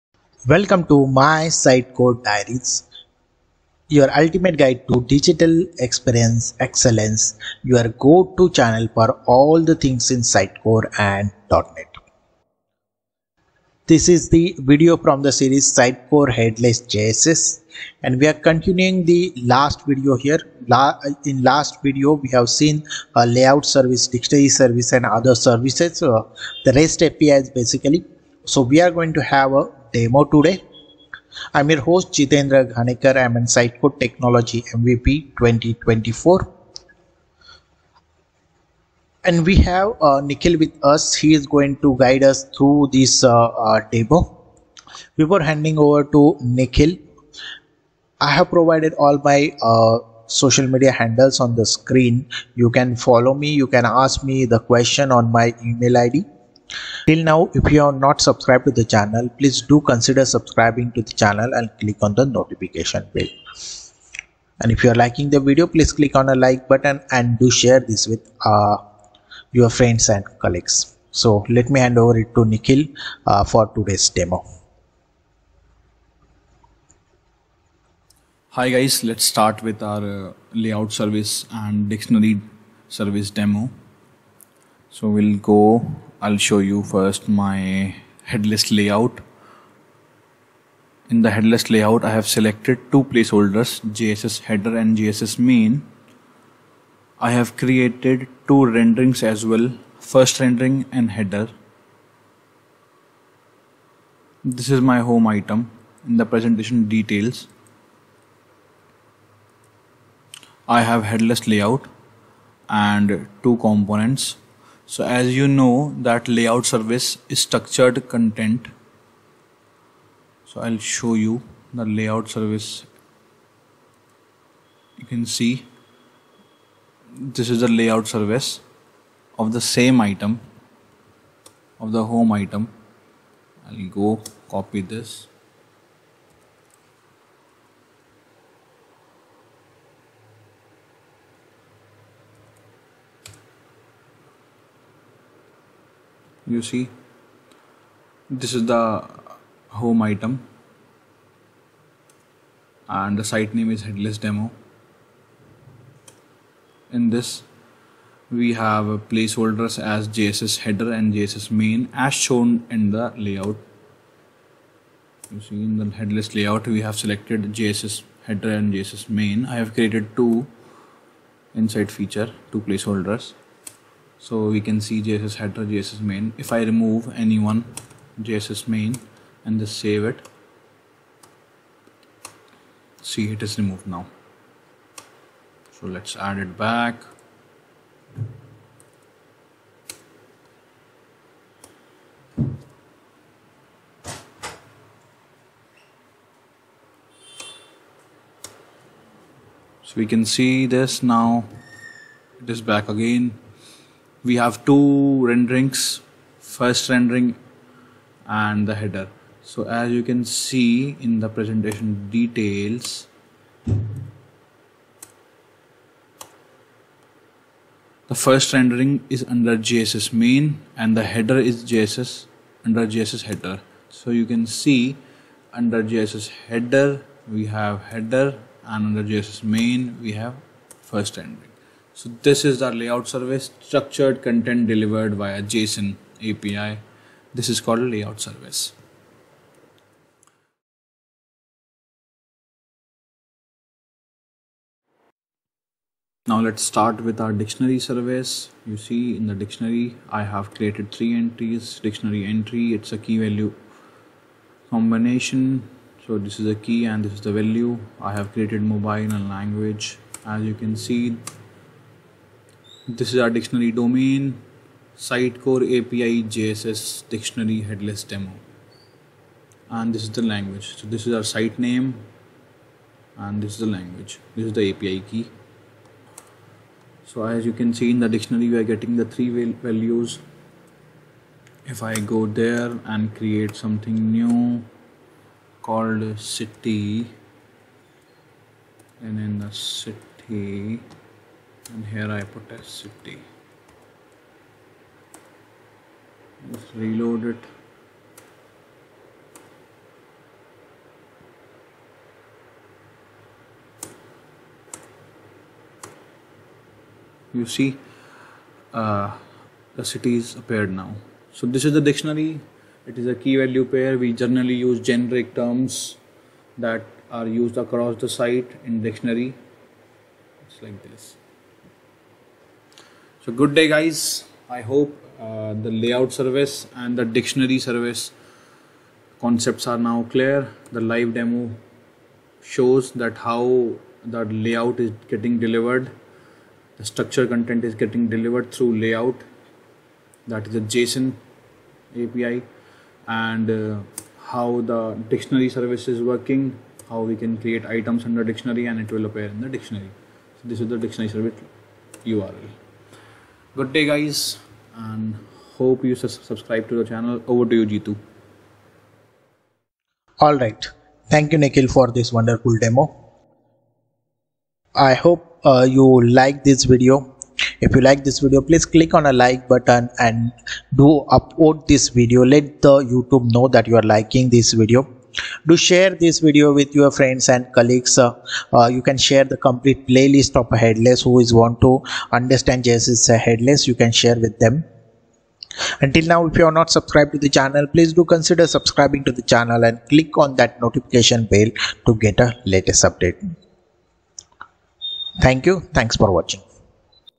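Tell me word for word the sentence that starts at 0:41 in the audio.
He is going to guide us through this uh, uh, demo.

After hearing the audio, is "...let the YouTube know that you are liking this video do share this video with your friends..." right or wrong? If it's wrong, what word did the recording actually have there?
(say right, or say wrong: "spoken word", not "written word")
right.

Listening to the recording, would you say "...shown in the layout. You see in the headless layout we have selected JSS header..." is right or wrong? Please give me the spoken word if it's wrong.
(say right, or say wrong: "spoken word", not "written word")
right.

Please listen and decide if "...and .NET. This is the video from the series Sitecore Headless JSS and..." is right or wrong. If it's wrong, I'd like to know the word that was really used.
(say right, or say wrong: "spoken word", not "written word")
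right.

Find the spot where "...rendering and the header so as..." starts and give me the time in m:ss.
3:26.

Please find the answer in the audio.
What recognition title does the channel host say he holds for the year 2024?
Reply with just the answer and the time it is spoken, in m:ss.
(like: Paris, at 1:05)
Code Technology MVP, at 0:33.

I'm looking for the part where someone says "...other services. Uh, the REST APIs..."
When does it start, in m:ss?
0:25.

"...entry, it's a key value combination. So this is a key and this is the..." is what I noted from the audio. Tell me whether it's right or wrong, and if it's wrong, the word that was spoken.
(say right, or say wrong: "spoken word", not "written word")
right.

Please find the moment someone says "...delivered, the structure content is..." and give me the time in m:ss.
5:35.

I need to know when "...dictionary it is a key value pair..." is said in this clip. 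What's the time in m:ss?
5:11.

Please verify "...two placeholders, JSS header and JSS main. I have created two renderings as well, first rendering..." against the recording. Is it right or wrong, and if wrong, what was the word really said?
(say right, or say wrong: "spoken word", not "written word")
right.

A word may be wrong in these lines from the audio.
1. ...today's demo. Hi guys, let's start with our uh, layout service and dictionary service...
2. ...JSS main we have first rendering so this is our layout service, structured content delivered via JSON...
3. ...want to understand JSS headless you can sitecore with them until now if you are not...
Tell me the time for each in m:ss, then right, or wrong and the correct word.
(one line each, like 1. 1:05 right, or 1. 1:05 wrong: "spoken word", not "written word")
1. 1:13 right
2. 3:49 right
3. 6:21 wrong: "share", not "sitecore".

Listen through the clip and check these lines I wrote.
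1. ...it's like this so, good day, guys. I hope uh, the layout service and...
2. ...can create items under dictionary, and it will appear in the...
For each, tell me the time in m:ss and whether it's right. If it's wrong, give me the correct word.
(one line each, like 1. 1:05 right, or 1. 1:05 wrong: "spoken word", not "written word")
1. 5:20 right
2. 5:47 right.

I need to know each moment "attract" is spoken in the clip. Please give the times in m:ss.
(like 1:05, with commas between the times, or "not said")
not said.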